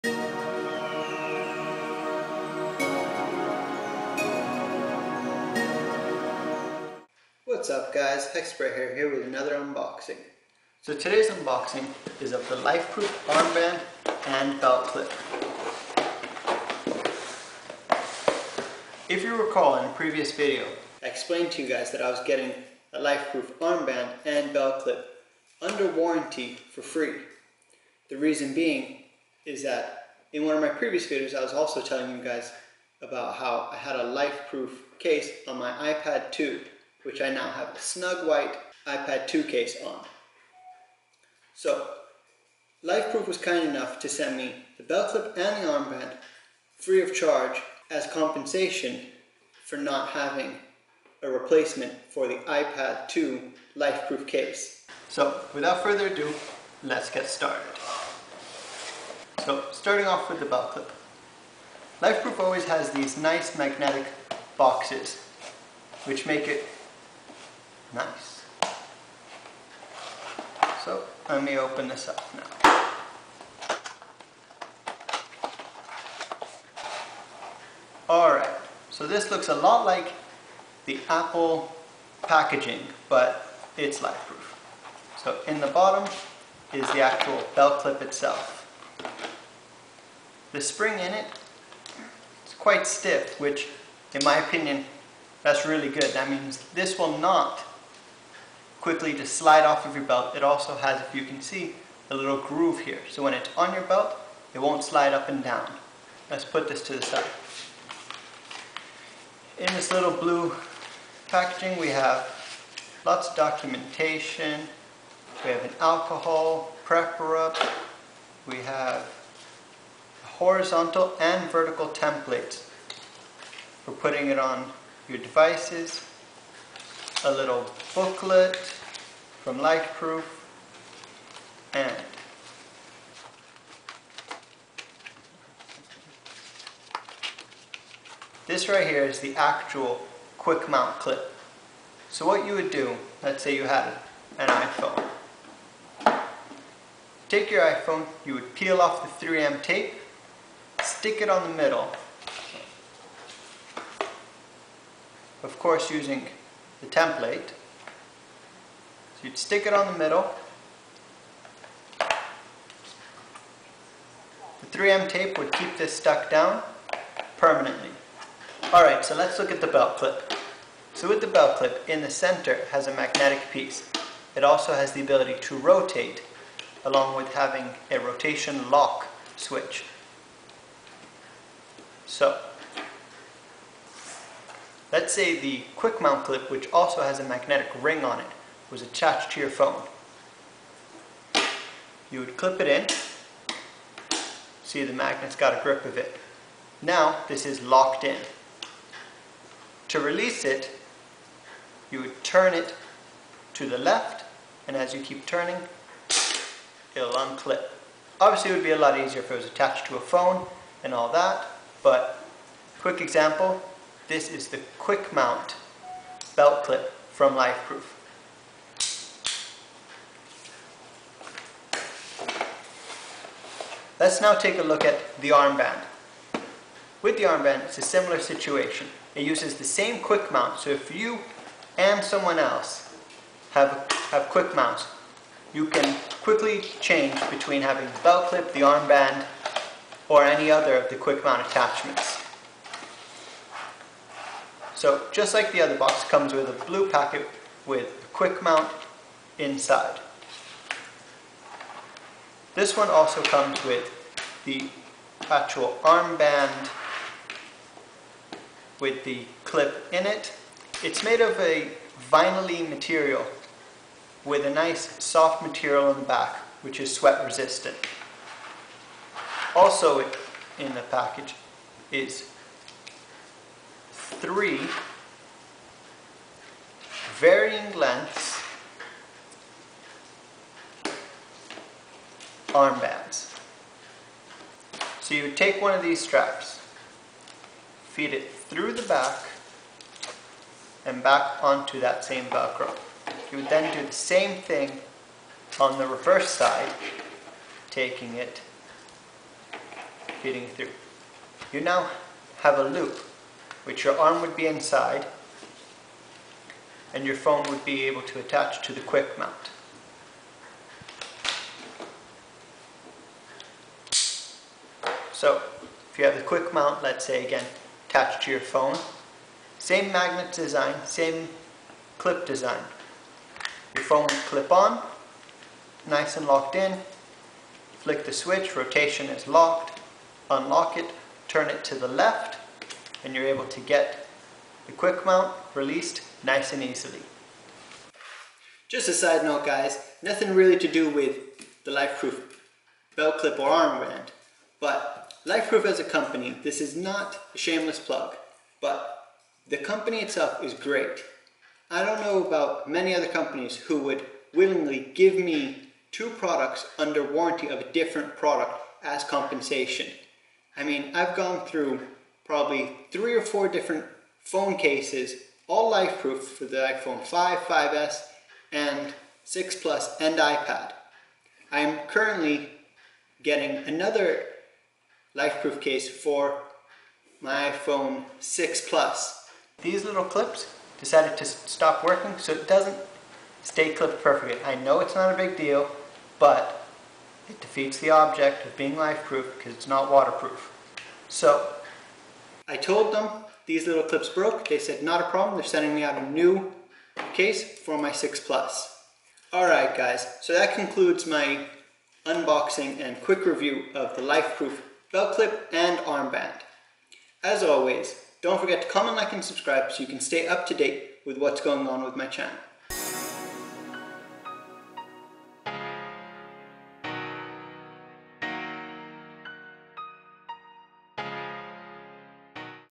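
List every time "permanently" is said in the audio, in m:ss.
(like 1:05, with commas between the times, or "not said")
2:47.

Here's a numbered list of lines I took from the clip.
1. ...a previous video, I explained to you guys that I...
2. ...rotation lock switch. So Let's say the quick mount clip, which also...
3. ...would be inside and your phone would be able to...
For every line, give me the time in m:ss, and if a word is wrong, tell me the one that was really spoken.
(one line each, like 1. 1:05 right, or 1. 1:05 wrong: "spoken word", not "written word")
1. 0:19 right
2. 2:57 right
3. 5:04 right.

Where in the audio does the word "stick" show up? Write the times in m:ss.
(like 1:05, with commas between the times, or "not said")
2:30, 2:39.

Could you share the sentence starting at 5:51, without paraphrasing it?
I don't know about many other companies who would willingly give me two products under warranty of a different product as compensation.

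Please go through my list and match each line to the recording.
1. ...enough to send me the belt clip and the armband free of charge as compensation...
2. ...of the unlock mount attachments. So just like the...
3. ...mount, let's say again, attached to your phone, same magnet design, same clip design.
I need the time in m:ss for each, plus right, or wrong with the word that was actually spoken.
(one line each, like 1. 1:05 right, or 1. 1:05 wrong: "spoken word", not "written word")
1. 0:43 right
2. 4:00 wrong: "quick", not "unlock"
3. 5:16 right.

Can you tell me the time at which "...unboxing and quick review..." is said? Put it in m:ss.
6:42.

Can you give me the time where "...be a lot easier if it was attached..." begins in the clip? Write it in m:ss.
3:28.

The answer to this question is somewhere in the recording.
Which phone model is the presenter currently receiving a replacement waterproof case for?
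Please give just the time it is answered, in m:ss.
6:17.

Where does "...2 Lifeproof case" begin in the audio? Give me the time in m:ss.
0:53.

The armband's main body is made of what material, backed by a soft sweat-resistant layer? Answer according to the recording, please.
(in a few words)
vinyl.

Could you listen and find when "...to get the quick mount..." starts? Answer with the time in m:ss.
5:33.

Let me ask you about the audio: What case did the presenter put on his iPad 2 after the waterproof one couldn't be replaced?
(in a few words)
snug white iPad 2 case.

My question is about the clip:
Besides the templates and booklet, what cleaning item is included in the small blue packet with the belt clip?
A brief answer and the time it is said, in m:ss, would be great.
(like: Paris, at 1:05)
alcohol rub, at 1:55.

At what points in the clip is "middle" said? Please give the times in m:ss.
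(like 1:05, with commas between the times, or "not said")
2:31, 2:39.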